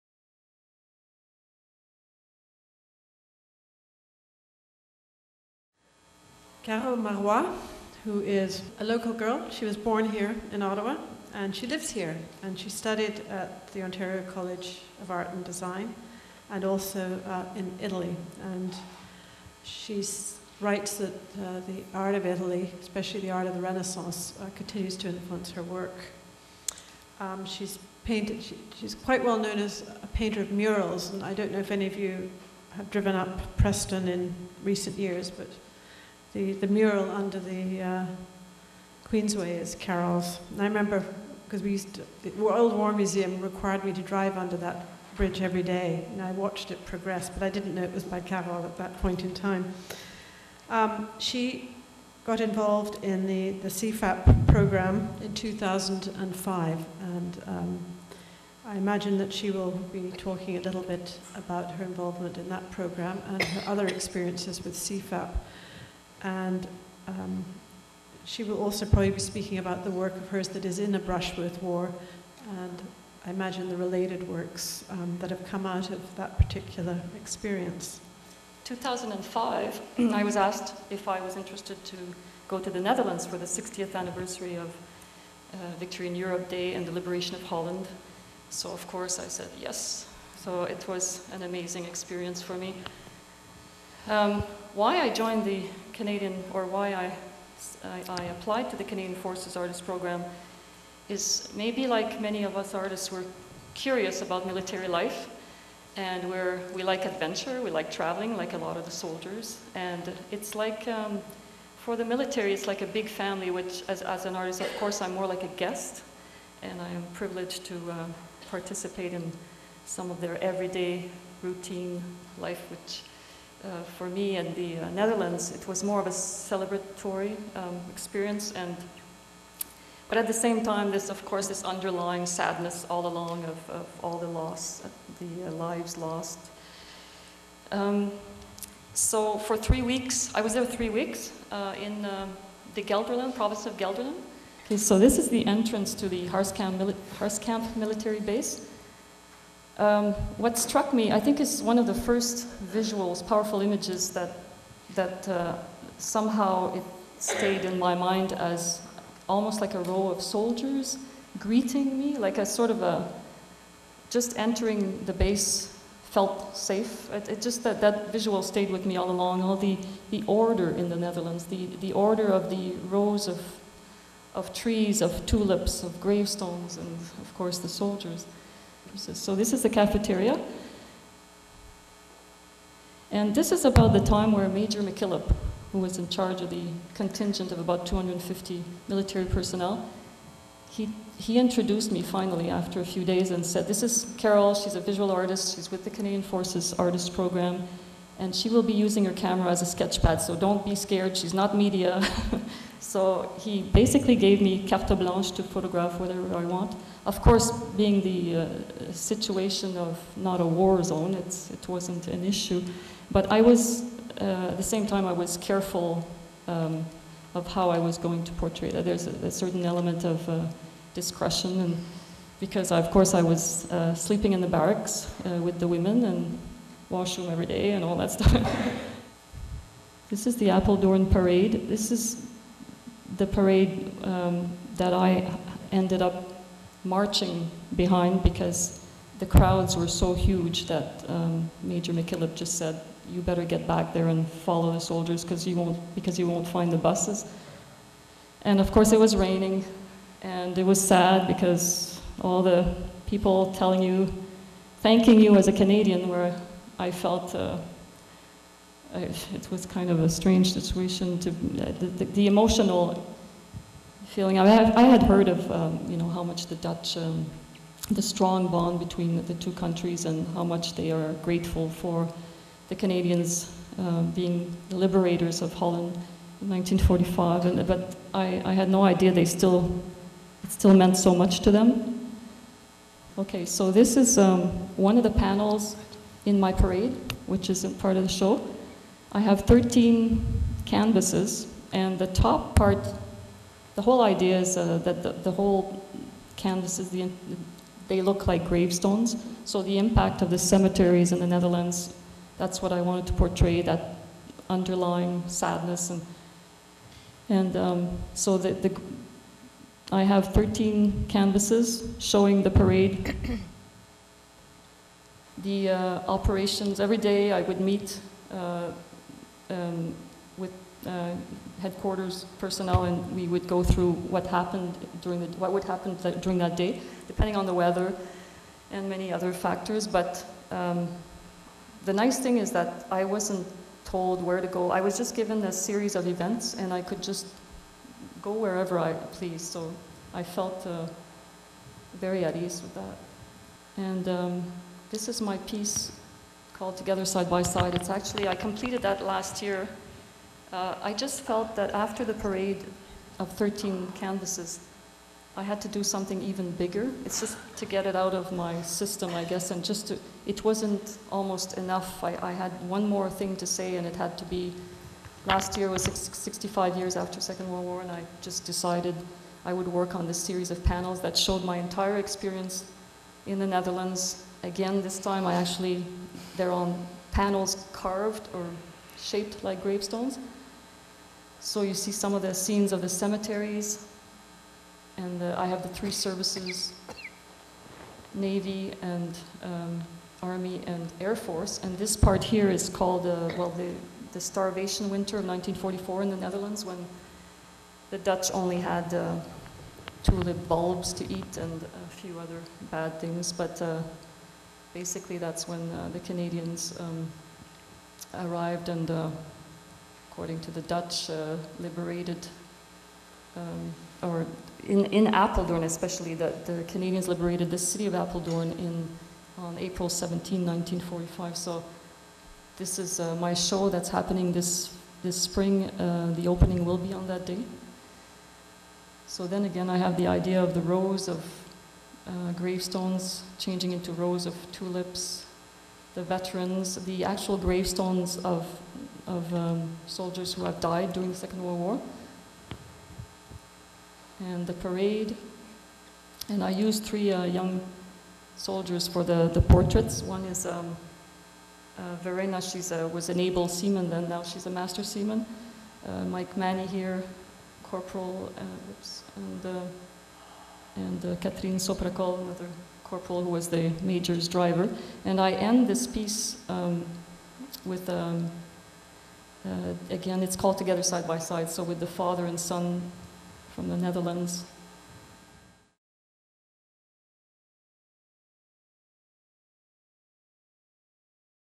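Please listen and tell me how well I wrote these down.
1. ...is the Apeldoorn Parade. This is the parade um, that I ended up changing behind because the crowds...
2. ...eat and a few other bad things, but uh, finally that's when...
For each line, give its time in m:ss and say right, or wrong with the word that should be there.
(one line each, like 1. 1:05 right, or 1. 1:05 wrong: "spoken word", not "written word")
1. 3:50 wrong: "marching", not "changing"
2. 6:41 wrong: "basically", not "finally".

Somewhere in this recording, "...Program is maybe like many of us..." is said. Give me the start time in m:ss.
1:39.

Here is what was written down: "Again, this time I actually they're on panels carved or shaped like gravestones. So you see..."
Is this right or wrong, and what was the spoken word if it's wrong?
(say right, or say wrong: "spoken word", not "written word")
right.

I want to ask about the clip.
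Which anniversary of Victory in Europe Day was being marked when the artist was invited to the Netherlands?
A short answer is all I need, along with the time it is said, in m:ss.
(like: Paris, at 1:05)
60th, at 1:23.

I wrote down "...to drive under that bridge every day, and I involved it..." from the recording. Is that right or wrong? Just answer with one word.
wrong.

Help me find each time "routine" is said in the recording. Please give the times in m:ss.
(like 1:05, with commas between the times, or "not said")
2:01.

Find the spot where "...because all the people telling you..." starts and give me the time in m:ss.
4:11.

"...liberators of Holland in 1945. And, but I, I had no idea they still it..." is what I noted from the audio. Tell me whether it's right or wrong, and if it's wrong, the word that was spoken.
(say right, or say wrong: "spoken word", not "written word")
right.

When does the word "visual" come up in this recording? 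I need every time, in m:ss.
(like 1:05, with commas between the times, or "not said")
2:32, 2:48, 3:14.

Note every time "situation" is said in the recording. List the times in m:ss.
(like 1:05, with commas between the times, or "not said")
3:28, 4:20.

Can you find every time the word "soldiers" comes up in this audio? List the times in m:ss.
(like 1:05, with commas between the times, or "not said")
1:48, 2:40, 2:57, 4:04, 7:19, 7:28.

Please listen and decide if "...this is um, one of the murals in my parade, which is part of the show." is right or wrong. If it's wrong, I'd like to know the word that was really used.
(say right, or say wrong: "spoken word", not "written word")
wrong: "panels", not "murals".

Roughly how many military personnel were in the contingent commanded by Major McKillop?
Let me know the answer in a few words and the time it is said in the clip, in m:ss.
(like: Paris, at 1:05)
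250, at 3:07.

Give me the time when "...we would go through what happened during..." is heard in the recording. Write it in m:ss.
5:23.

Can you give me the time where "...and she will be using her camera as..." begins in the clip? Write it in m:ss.
3:18.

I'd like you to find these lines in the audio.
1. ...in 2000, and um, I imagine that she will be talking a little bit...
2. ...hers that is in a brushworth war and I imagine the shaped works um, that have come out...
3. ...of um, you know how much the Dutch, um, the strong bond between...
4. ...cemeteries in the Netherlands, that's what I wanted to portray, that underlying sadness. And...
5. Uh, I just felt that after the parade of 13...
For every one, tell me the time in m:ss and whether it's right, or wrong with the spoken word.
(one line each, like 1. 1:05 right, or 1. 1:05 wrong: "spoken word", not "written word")
1. 0:55 wrong: "2005", not "2000"
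2. 1:10 wrong: "related", not "shaped"
3. 4:25 right
4. 5:00 right
5. 5:50 right.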